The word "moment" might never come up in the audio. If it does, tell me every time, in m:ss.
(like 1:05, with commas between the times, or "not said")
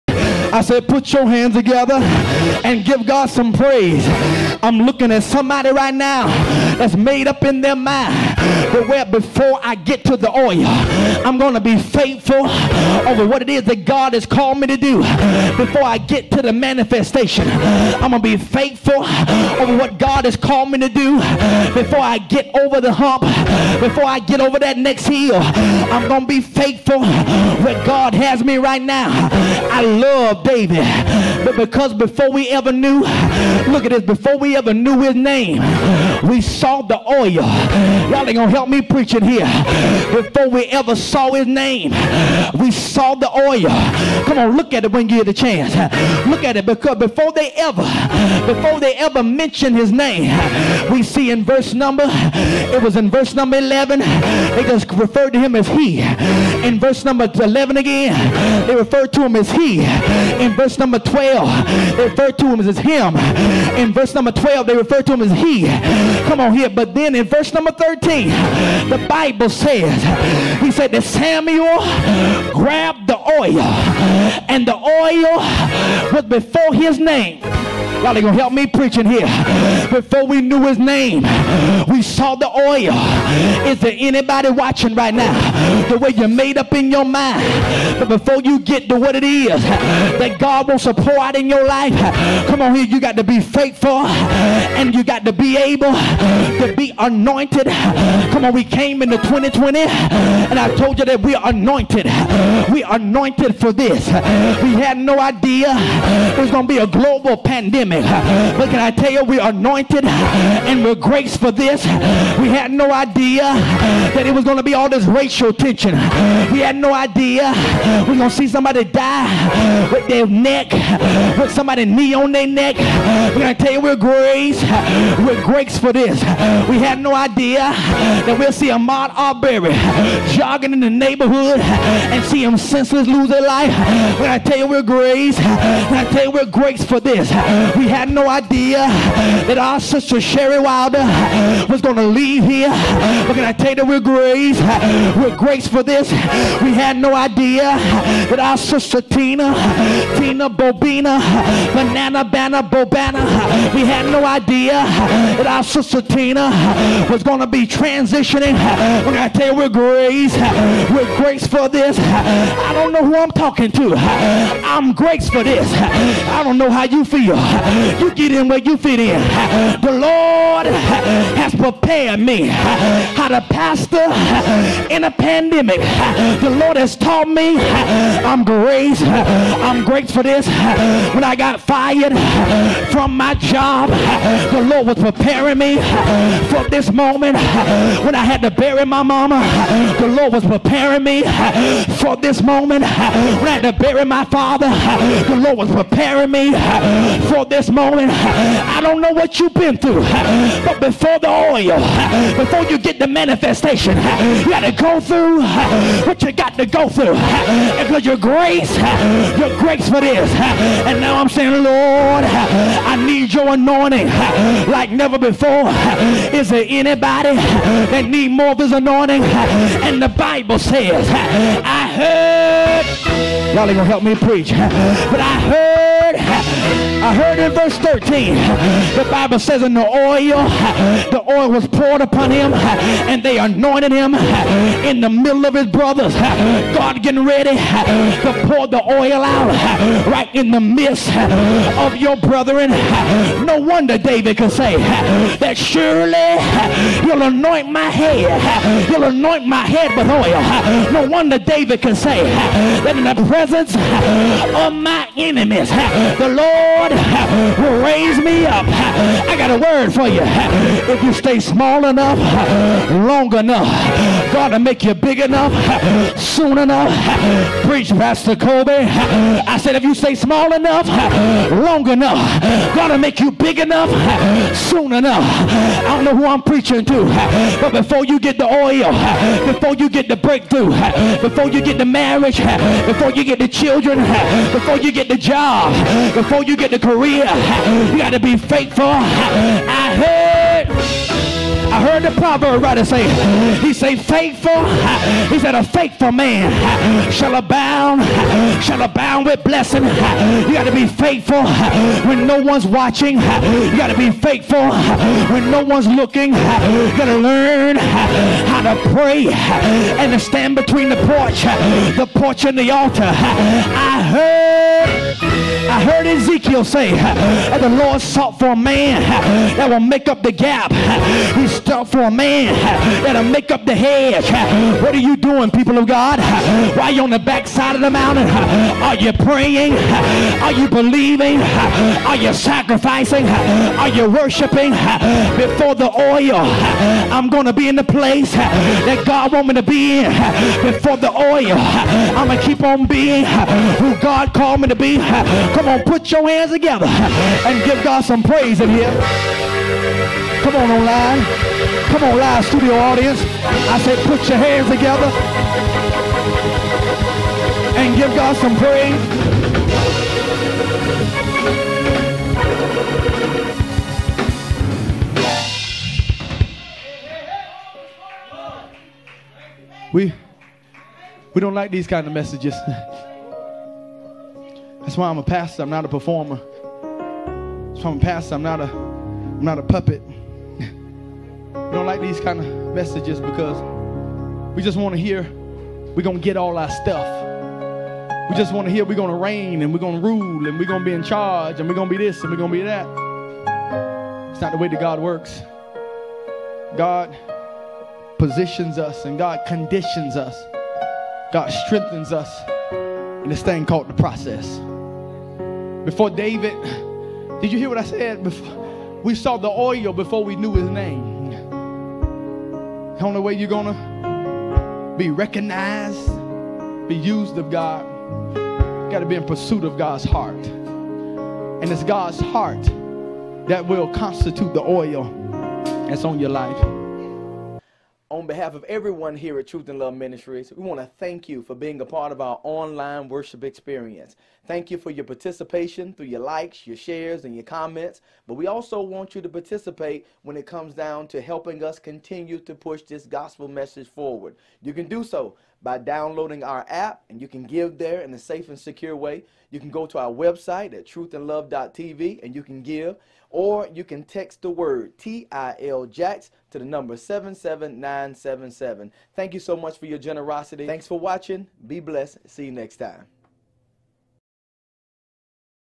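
3:06, 3:12, 3:17.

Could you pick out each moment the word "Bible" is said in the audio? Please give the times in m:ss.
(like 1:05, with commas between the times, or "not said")
1:09, 3:40, 3:49.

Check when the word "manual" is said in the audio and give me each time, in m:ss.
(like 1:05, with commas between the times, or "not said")
not said.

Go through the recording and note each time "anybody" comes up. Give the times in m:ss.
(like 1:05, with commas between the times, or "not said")
1:23, 3:36.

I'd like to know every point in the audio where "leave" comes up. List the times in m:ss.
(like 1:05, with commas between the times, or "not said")
2:22.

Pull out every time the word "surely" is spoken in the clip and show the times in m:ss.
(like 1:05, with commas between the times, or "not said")
4:05.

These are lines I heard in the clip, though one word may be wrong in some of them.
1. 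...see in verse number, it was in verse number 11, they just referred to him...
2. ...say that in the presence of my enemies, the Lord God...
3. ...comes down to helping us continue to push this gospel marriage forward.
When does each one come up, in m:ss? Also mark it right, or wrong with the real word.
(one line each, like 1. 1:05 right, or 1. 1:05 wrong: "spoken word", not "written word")
1. 0:51 right
2. 4:11 right
3. 7:20 wrong: "message", not "marriage".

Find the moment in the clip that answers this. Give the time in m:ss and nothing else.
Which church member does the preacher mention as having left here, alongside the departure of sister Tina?
2:20.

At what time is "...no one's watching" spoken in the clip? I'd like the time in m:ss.
5:02.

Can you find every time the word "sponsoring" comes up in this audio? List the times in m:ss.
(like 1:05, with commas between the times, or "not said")
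not said.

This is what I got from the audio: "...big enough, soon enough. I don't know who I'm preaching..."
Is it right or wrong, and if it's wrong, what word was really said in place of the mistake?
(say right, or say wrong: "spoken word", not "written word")
right.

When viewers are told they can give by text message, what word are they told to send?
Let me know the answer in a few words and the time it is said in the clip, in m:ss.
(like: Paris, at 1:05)
TIL, at 7:34.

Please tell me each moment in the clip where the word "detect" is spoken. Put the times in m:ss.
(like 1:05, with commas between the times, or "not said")
not said.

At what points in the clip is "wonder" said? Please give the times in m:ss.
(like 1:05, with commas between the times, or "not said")
4:03, 4:11.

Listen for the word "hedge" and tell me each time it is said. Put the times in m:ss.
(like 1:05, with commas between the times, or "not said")
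5:23.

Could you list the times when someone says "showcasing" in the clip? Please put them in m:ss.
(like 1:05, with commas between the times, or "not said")
not said.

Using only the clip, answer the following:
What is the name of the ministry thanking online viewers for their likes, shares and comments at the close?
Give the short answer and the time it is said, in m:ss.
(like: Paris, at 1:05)
Truth in Love Ministries, at 7:09.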